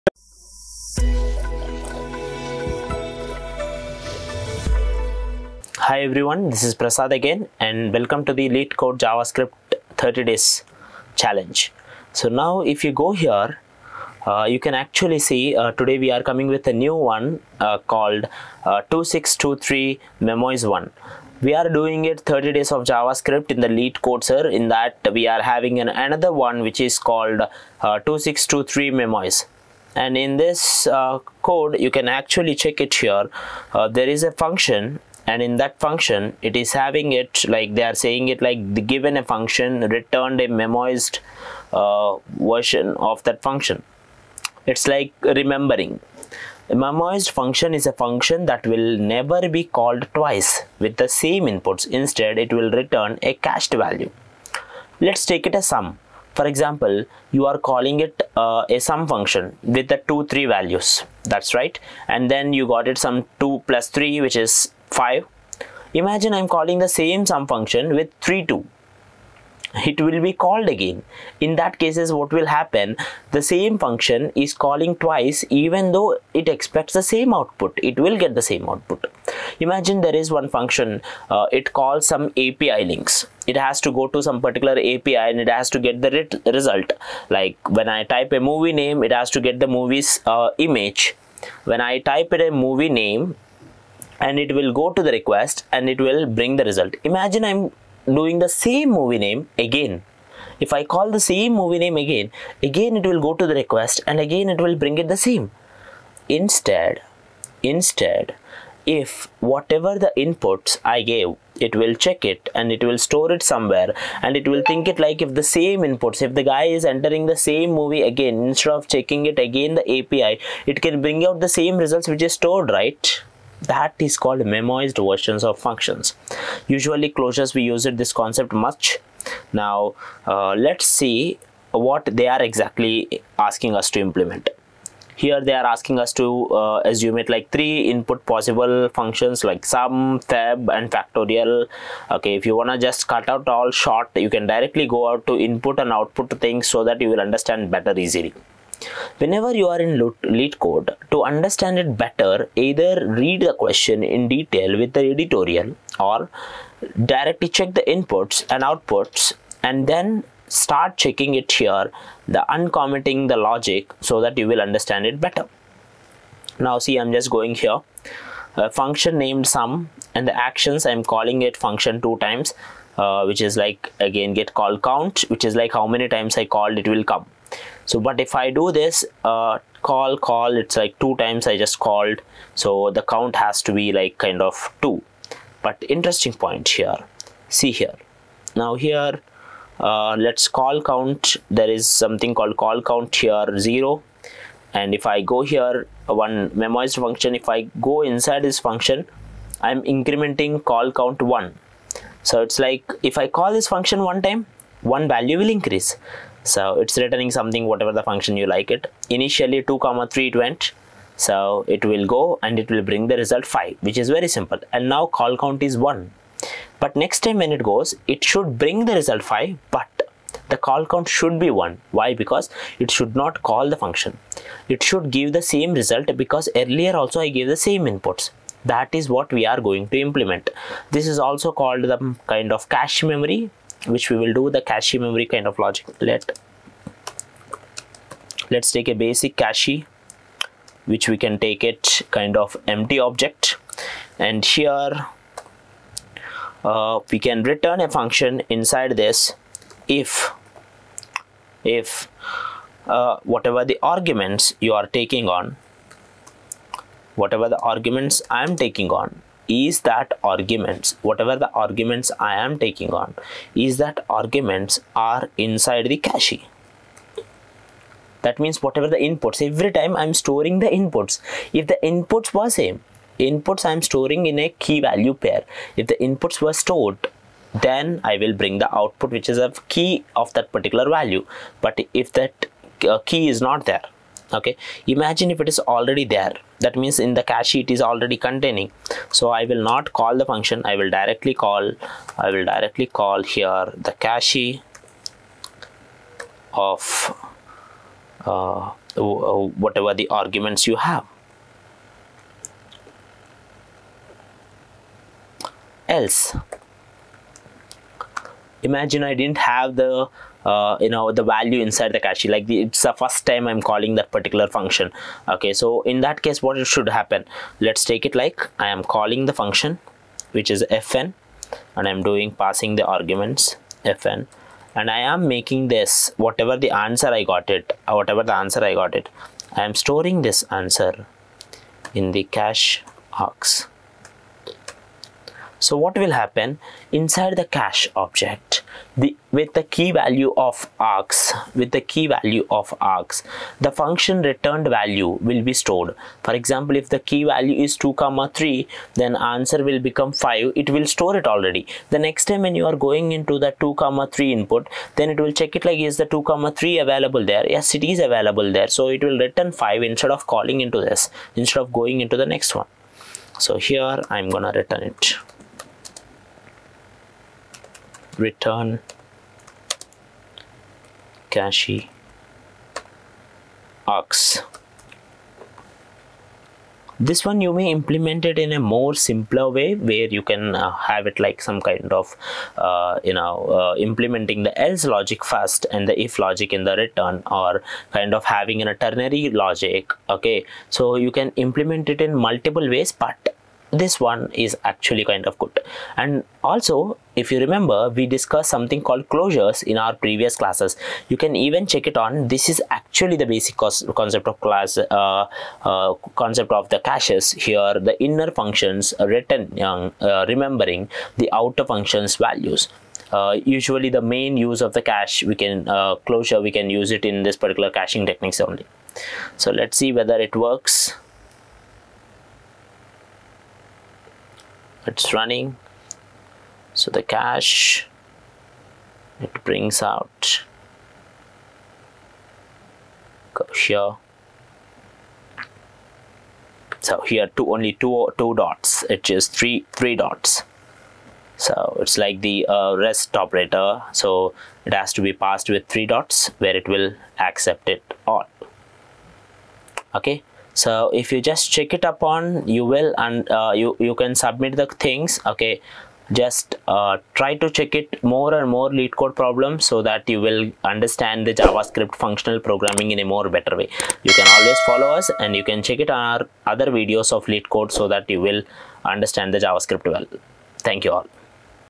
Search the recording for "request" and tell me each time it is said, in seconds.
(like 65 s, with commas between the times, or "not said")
95 s, 103 s.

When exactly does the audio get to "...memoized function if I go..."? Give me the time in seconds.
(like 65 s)
196 s.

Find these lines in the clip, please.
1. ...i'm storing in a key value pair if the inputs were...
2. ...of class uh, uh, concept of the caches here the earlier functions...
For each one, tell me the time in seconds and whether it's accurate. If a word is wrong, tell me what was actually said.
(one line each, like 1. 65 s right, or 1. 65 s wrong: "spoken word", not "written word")
1. 273 s right
2. 404 s wrong: "inner", not "earlier".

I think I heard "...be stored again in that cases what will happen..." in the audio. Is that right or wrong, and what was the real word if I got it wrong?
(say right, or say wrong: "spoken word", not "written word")
wrong: "called", not "stored".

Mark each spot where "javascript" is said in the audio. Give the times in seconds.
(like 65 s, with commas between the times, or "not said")
8 s, 22 s, 461 s, 469 s.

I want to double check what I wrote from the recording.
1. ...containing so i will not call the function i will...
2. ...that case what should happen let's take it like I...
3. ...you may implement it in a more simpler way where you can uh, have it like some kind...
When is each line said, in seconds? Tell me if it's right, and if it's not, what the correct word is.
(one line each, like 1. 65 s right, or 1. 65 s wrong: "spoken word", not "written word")
1. 288 s right
2. 316 s right
3. 377 s right.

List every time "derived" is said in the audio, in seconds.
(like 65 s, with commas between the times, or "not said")
not said.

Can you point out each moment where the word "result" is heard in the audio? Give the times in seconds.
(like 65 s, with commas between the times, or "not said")
86 s, 96 s, 121 s, 213 s, 218 s, 225 s.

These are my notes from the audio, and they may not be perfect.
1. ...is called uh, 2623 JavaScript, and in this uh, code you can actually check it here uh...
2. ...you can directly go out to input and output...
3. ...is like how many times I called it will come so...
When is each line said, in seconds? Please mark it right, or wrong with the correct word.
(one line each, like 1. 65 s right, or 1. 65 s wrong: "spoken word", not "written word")
1. 26 s wrong: "Memoise", not "JavaScript"
2. 144 s right
3. 175 s right.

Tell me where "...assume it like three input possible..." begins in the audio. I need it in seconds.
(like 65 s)
136 s.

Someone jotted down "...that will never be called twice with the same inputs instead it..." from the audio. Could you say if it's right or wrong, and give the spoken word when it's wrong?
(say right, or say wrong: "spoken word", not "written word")
right.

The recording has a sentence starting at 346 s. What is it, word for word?
For example if the key value is 2 comma 3 then answer will become 5 it will store it already.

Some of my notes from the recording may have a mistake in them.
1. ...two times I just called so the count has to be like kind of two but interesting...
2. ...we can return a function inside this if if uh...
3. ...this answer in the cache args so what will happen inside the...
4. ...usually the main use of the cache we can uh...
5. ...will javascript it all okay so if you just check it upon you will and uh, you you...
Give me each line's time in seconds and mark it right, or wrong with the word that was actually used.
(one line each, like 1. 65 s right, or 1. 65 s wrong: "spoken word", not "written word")
1. 180 s right
2. 247 s right
3. 330 s right
4. 413 s right
5. 446 s wrong: "accept", not "javascript".